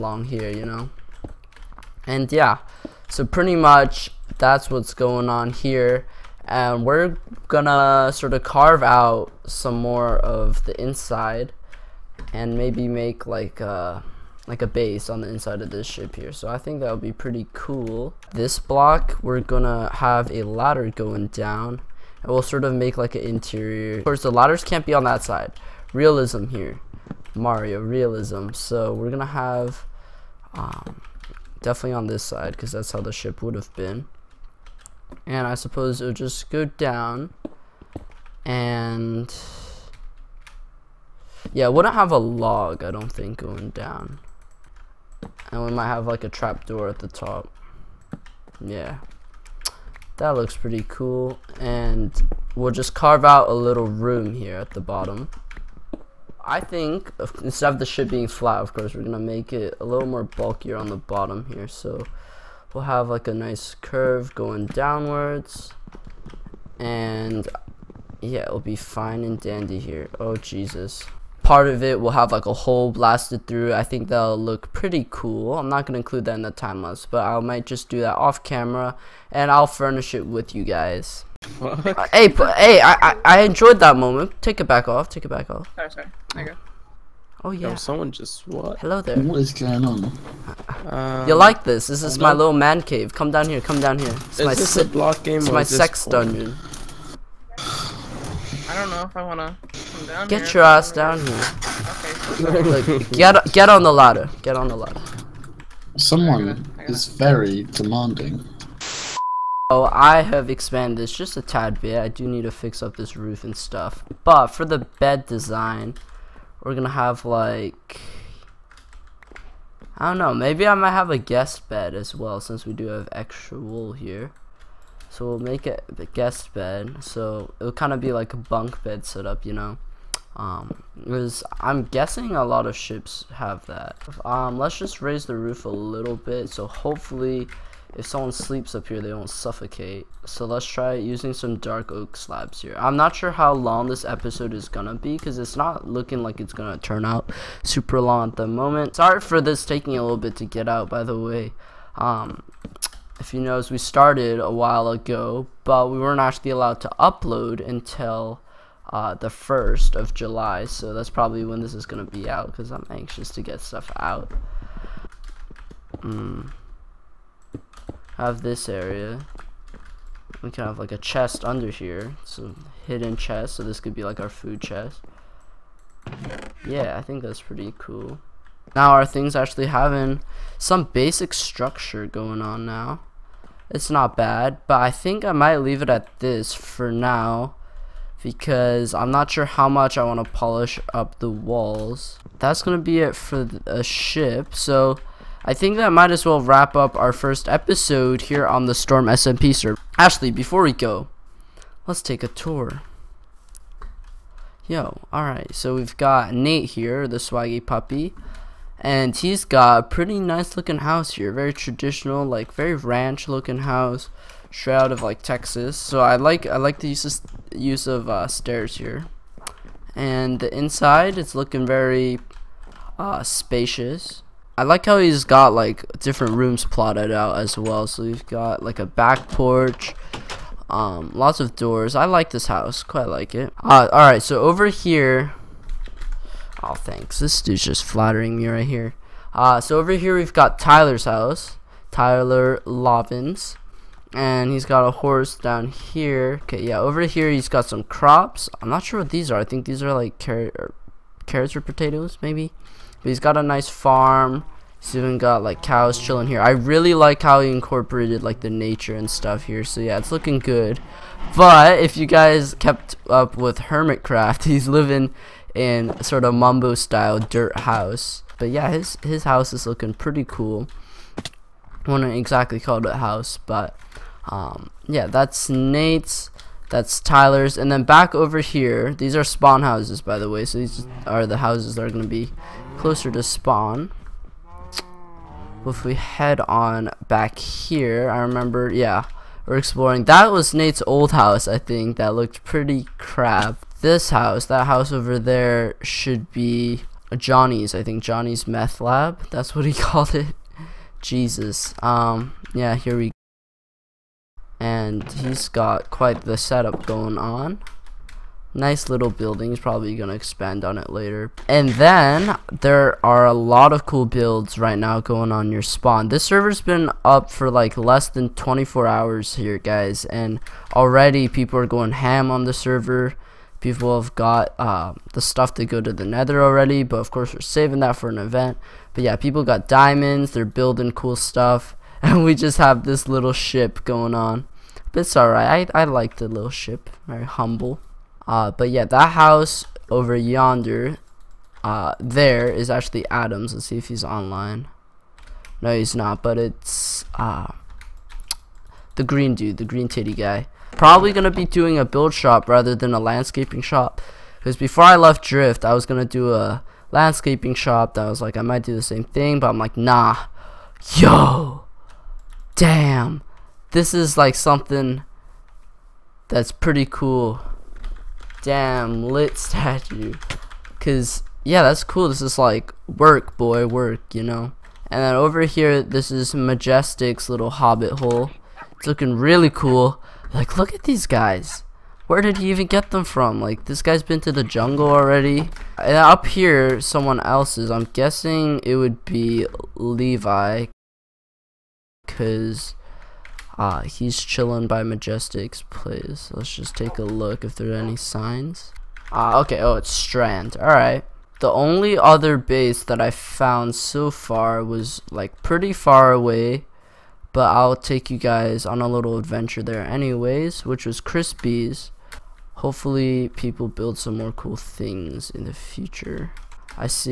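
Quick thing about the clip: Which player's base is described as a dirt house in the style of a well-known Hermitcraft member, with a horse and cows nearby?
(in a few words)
Tyler Lovins.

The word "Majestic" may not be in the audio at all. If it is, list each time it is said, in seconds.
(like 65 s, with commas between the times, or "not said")
376 s, 394 s.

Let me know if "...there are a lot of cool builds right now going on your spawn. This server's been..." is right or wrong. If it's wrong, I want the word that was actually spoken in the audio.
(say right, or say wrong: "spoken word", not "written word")
right.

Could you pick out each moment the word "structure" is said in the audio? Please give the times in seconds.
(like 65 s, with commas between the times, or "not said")
181 s.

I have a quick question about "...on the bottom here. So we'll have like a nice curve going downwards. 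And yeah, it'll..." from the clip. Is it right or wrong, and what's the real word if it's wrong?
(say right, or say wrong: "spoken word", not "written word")
right.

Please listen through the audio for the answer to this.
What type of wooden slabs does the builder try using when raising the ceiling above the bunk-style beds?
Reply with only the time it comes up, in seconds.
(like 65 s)
141 s.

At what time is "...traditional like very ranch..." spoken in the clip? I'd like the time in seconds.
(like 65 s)
211 s.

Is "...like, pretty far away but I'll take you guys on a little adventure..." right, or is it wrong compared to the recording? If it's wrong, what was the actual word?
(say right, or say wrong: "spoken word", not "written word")
right.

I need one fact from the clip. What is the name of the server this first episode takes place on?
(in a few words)
Storm SMP.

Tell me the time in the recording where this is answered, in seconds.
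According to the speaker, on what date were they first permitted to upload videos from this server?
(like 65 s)
159 s.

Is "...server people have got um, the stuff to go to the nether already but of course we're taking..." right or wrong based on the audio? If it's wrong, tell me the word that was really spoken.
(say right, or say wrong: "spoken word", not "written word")
wrong: "saving", not "taking".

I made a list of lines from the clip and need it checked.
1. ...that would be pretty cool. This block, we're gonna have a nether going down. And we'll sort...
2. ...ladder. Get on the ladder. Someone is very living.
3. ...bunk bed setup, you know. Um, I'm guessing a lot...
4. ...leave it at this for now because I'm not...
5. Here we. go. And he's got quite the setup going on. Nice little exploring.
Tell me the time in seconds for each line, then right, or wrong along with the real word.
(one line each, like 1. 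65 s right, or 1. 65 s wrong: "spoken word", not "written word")
1. 16 s wrong: "ladder", not "nether"
2. 103 s wrong: "demanding", not "living"
3. 128 s right
4. 185 s right
5. 302 s wrong: "building", not "exploring".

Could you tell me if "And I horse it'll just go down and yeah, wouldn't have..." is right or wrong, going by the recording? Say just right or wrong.
wrong.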